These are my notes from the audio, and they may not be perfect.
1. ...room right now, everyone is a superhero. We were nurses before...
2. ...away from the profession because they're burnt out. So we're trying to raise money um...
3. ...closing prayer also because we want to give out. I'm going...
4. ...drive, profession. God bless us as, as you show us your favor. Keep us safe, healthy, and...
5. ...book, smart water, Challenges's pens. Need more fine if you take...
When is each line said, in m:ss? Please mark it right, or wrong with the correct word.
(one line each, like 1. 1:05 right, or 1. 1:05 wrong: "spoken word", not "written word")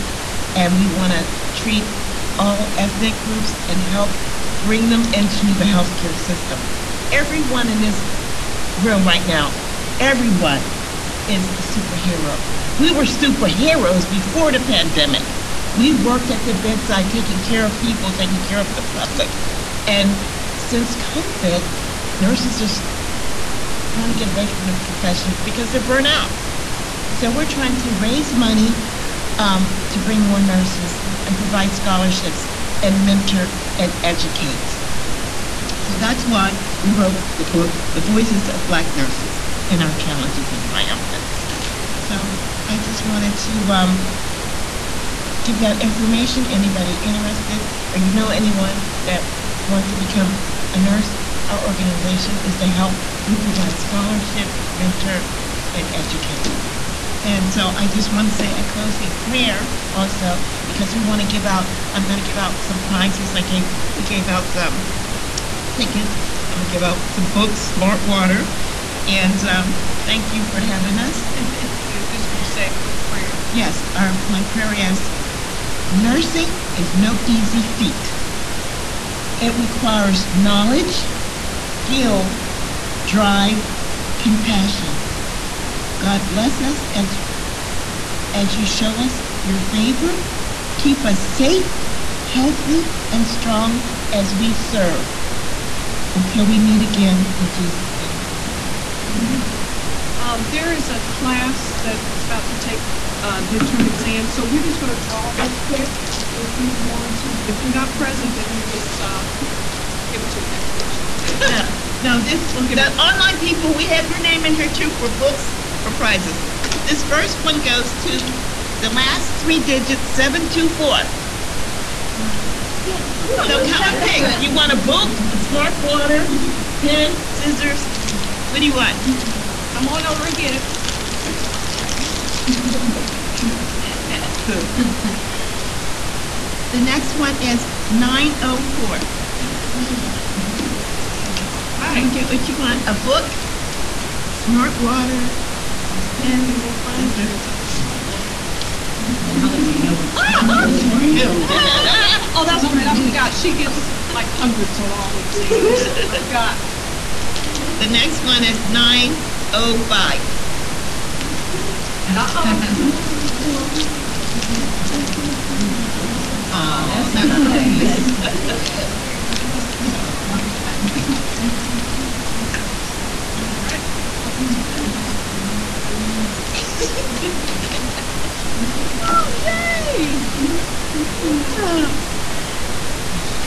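1. 0:08 wrong: "superheroes", not "nurses"
2. 0:24 right
3. 0:58 right
4. 1:23 wrong: "compassion", not "profession"
5. 2:22 wrong: "There", not "Challenges".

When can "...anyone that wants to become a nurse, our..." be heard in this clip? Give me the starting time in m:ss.
0:48.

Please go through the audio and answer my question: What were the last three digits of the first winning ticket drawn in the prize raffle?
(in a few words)
724.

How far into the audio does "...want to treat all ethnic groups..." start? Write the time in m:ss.
0:00.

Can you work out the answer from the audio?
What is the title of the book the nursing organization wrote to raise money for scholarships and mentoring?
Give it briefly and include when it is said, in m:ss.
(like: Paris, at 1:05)
The Voices of Black Nurses, at 0:37.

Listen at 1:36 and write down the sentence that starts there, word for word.
Until we meet again, in Jesus' name, amen.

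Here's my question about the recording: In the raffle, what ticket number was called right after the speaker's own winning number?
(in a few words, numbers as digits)
905.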